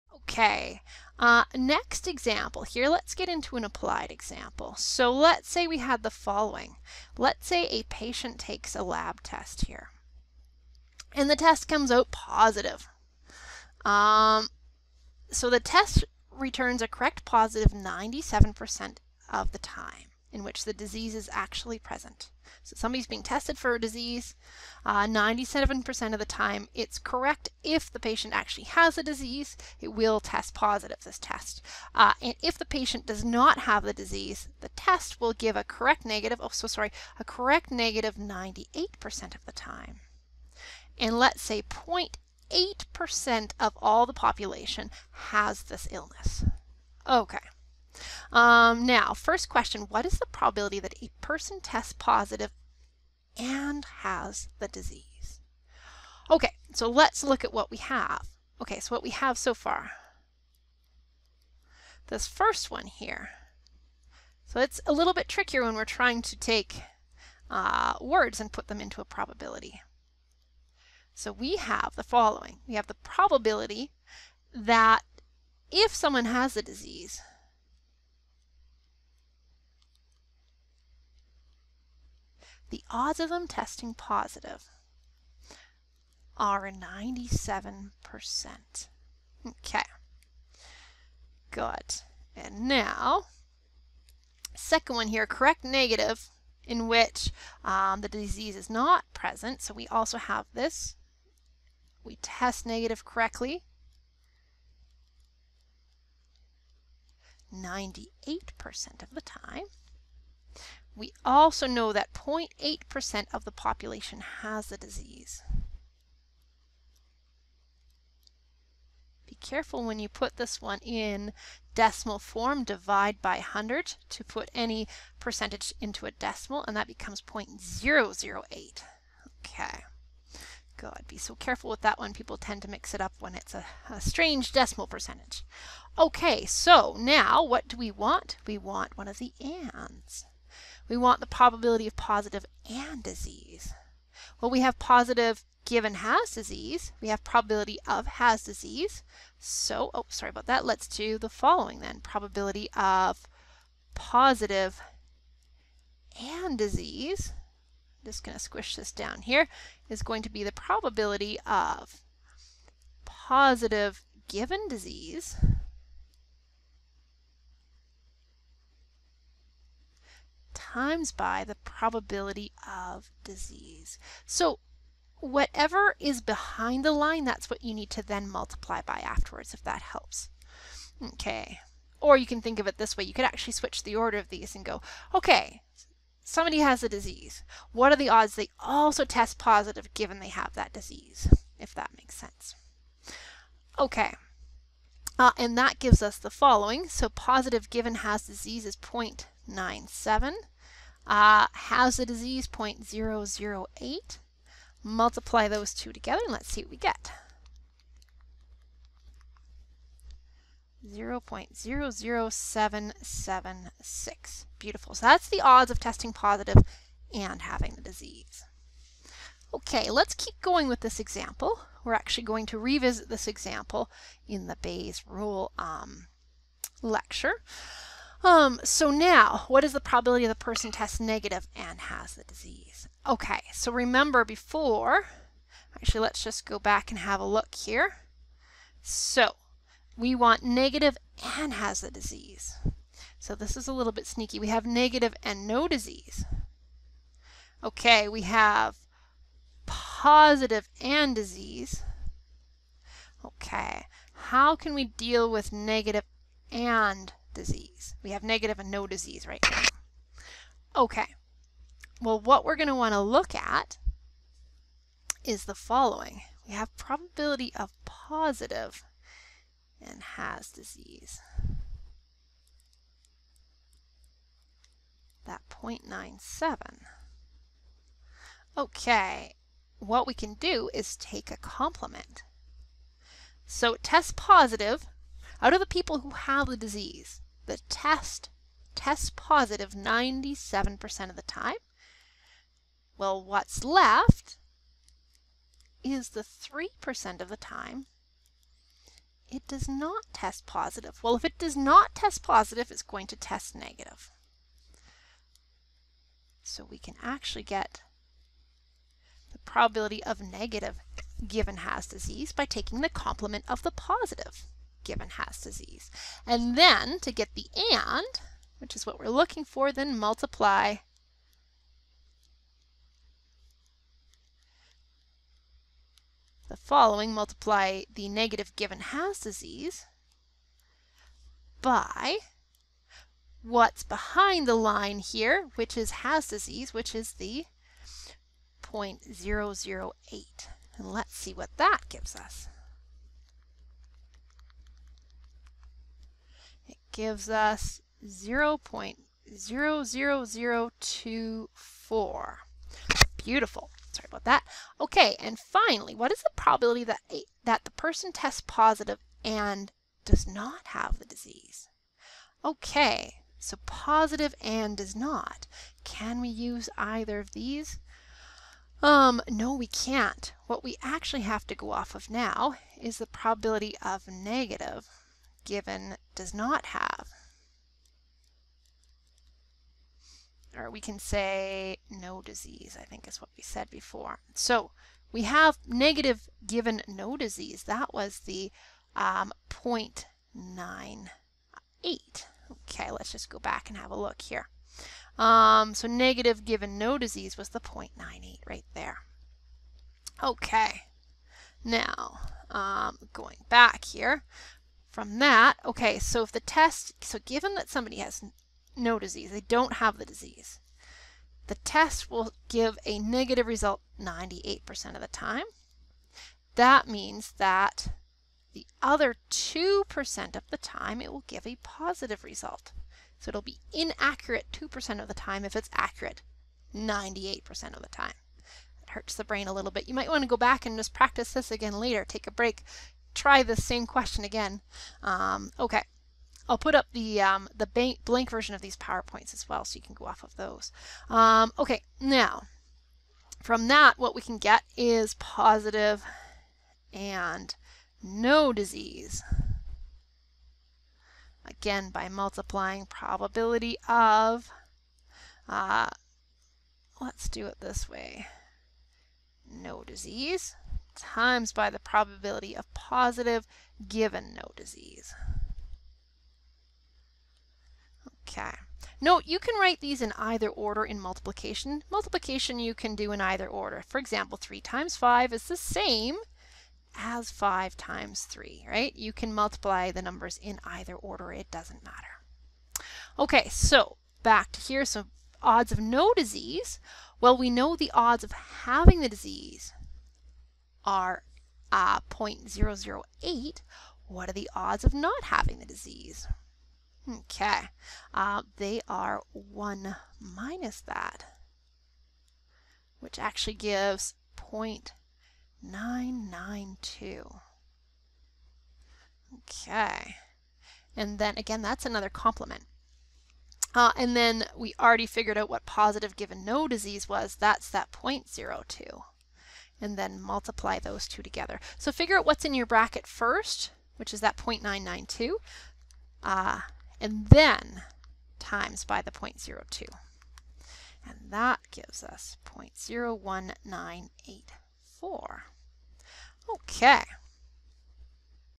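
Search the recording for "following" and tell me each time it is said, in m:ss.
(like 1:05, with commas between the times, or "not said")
0:06, 1:12, 2:31, 3:16, 4:25, 5:26.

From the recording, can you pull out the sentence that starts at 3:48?
Um, so now, what is the probability the person tests negative and has the disease?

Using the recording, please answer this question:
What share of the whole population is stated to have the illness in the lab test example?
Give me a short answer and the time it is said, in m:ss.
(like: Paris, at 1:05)
0.8%, at 0:41.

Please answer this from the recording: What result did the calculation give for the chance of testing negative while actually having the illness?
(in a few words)
0.00024.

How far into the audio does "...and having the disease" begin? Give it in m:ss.
3:37.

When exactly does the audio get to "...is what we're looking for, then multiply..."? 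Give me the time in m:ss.
5:18.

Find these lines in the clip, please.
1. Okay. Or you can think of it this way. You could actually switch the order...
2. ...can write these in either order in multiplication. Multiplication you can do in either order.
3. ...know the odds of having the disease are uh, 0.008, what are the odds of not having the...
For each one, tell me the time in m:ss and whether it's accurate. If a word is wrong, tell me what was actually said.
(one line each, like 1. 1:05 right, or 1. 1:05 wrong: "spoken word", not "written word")
1. 3:01 right
2. 7:49 right
3. 8:07 right.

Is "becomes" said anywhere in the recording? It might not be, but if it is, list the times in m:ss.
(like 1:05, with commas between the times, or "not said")
2:06.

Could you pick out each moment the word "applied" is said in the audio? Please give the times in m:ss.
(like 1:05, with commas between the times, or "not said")
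0:03.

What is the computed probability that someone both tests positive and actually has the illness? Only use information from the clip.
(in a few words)
0.00776.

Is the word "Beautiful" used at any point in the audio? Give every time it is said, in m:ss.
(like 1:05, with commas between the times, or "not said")
3:34, 5:53.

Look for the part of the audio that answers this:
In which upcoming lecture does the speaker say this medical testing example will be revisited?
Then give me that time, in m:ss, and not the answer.
3:44.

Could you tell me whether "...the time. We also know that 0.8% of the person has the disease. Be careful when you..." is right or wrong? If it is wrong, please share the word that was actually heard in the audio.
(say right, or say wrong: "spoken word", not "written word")
wrong: "population", not "person".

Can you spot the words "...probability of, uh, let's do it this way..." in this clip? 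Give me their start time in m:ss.
7:32.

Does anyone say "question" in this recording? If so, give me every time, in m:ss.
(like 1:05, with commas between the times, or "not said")
0:49, 7:13.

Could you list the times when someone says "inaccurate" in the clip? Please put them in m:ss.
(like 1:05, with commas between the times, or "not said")
7:03.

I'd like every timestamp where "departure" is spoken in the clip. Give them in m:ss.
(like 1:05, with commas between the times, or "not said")
not said.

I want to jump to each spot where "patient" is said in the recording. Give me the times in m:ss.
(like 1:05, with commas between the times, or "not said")
0:07, 0:27, 0:32.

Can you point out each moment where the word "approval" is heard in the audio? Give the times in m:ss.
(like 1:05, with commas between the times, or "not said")
not said.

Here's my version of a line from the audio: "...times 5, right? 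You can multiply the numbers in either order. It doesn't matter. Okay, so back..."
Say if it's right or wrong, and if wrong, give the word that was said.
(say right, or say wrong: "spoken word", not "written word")
wrong: "3", not "5".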